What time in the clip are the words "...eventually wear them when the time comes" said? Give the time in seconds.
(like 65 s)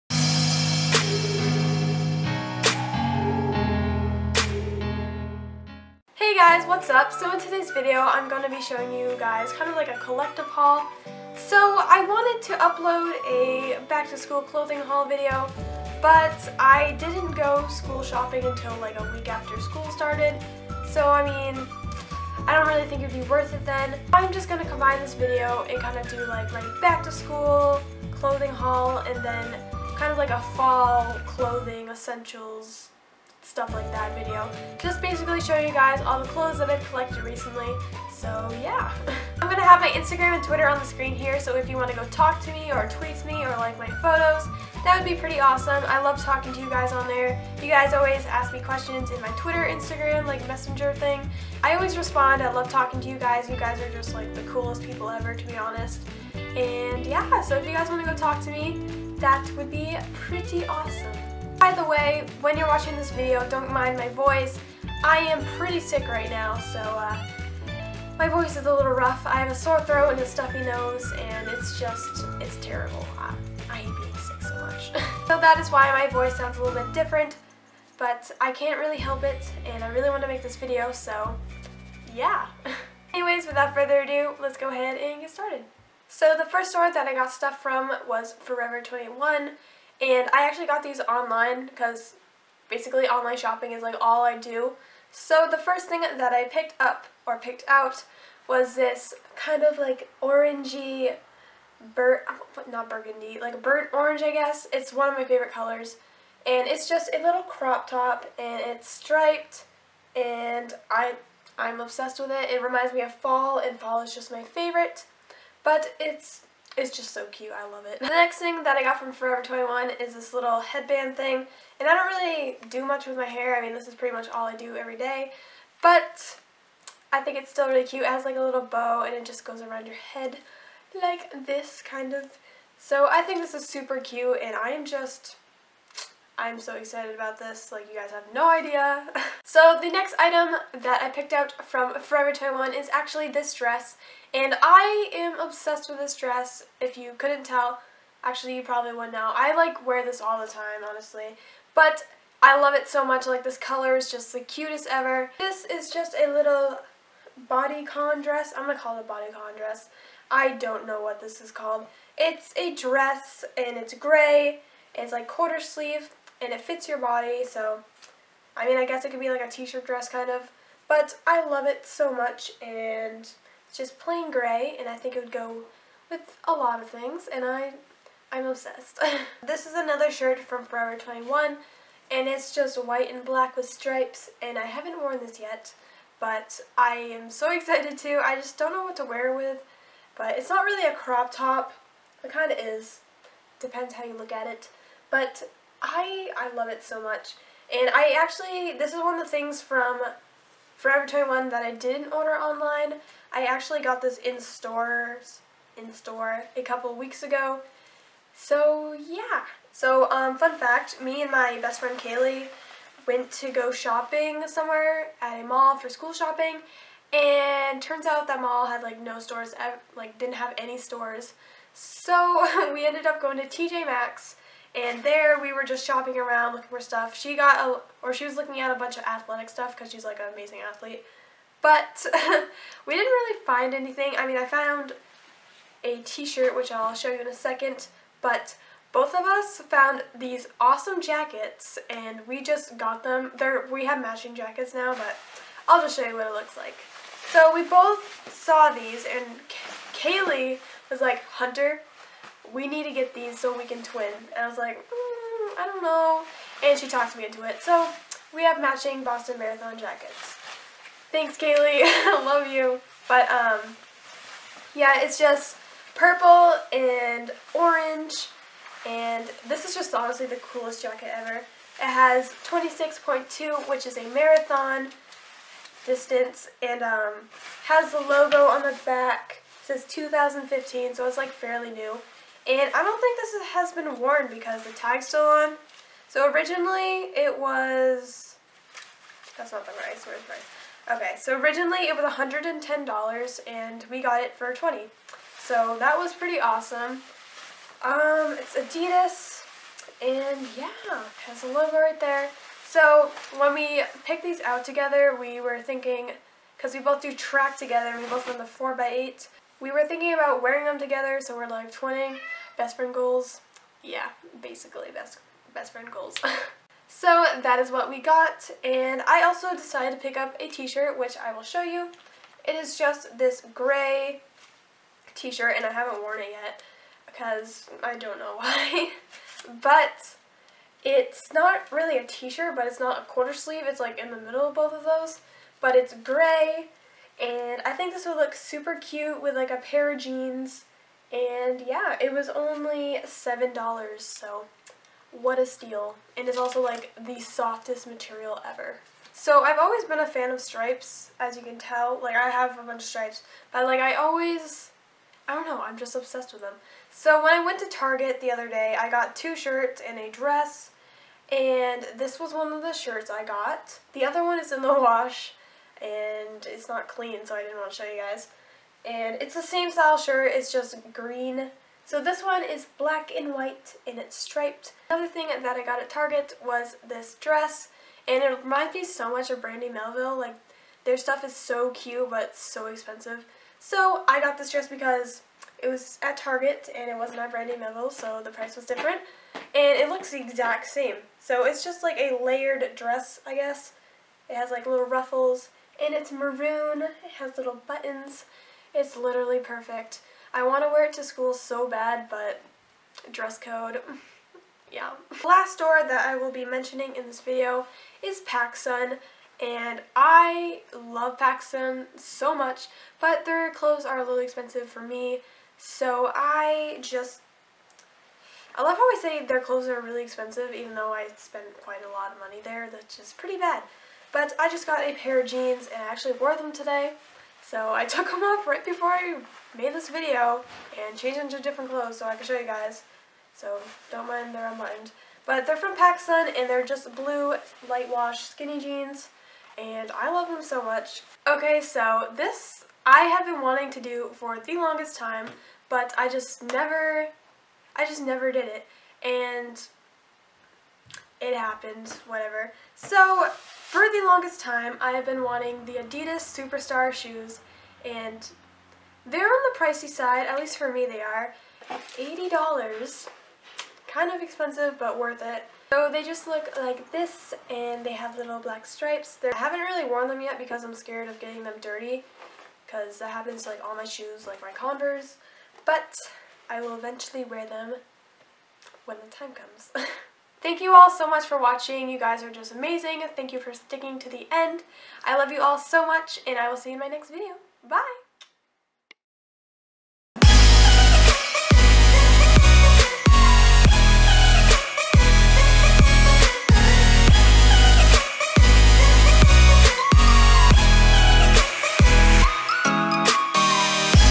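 476 s.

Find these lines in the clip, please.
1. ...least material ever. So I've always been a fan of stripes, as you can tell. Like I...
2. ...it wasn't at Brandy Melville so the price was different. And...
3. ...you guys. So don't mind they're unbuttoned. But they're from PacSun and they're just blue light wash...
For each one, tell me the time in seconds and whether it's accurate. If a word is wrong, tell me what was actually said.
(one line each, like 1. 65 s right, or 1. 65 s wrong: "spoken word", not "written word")
1. 347 s wrong: "softest", not "least"
2. 386 s right
3. 432 s right.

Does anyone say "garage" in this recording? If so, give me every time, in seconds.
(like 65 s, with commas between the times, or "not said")
not said.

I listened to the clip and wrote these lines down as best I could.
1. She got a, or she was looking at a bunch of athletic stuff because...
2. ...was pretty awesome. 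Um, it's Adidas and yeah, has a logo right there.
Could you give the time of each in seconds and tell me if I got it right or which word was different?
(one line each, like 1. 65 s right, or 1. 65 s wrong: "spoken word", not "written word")
1. 227 s right
2. 295 s right.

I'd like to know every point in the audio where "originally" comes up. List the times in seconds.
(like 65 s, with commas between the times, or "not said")
286 s, 291 s.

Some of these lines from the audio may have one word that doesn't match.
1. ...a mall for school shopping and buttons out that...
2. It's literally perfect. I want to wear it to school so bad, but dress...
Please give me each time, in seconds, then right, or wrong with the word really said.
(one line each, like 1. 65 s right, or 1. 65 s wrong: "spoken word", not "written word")
1. 215 s wrong: "turns", not "buttons"
2. 398 s right.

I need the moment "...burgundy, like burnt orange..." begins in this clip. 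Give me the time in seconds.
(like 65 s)
102 s.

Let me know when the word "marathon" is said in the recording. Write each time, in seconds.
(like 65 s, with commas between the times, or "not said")
259 s, 274 s.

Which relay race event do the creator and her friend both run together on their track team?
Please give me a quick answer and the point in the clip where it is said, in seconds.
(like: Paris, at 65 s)
4x8, at 308 s.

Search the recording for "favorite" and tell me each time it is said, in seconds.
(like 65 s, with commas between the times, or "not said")
105 s, 114 s.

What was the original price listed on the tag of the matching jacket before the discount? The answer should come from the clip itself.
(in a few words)
$110.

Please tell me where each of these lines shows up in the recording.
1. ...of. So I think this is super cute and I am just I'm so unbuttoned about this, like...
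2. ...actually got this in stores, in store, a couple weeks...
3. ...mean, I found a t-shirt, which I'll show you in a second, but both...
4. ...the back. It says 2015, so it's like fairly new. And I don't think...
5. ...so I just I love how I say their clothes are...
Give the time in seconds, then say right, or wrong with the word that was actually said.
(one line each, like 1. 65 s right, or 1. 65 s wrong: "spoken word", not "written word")
1. 132 s wrong: "excited", not "unbuttoned"
2. 203 s right
3. 234 s right
4. 278 s right
5. 415 s right.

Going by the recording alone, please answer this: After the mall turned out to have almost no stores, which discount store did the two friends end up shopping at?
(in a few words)
TJ Maxx.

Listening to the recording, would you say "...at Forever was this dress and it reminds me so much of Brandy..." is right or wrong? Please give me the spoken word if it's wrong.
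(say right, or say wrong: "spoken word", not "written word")
wrong: "Target", not "Forever".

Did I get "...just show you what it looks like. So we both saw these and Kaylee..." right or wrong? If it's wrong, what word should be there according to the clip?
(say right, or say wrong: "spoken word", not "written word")
right.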